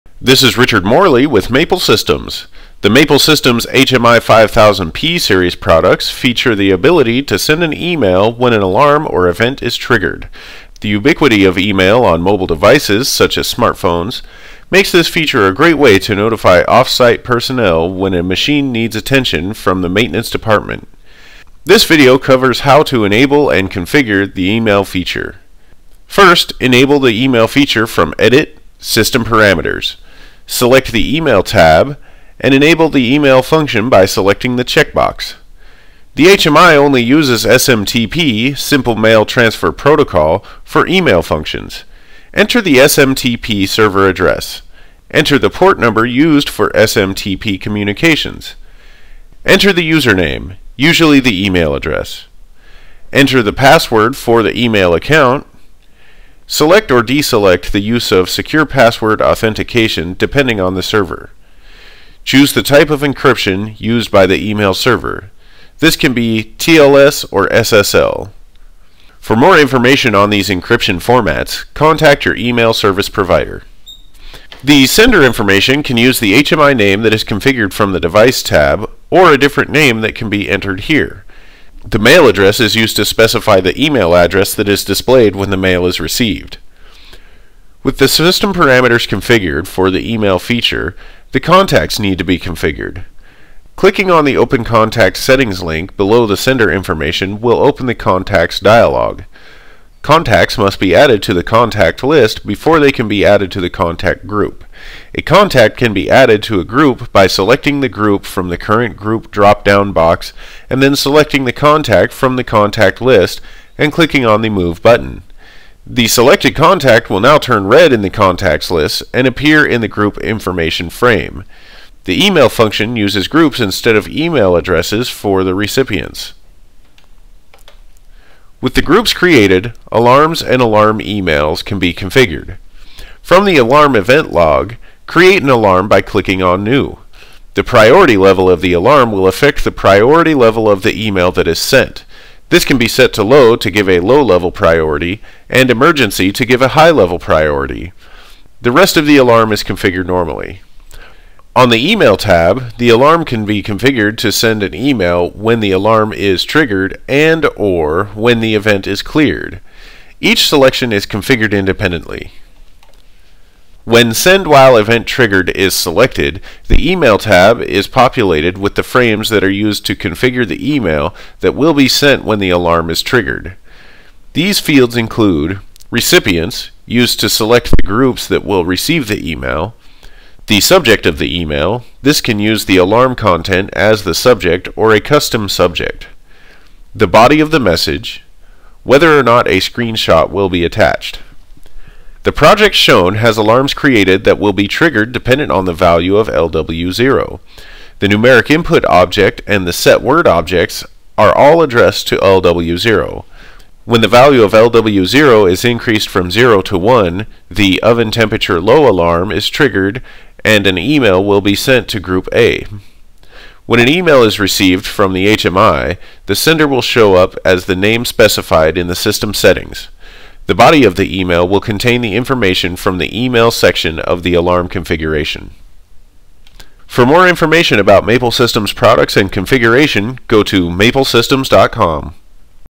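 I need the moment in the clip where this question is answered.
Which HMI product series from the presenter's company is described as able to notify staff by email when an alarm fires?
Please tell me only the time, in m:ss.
0:04.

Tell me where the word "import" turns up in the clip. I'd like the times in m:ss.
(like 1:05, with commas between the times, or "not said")
not said.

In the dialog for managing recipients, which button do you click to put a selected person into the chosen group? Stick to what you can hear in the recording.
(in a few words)
Move.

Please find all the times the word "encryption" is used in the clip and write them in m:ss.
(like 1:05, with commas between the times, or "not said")
1:02, 1:10.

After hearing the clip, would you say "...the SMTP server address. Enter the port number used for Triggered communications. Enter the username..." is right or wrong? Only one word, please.
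wrong.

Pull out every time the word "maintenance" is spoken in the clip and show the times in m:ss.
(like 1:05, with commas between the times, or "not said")
0:19.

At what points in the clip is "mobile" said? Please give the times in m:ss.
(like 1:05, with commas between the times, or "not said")
0:12.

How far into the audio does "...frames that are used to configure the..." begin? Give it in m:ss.
2:48.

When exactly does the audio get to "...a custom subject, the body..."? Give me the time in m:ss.
3:04.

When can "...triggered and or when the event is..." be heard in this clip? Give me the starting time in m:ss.
2:36.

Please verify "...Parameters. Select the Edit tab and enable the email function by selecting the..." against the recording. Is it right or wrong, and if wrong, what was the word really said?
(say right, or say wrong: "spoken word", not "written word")
wrong: "Email", not "Edit".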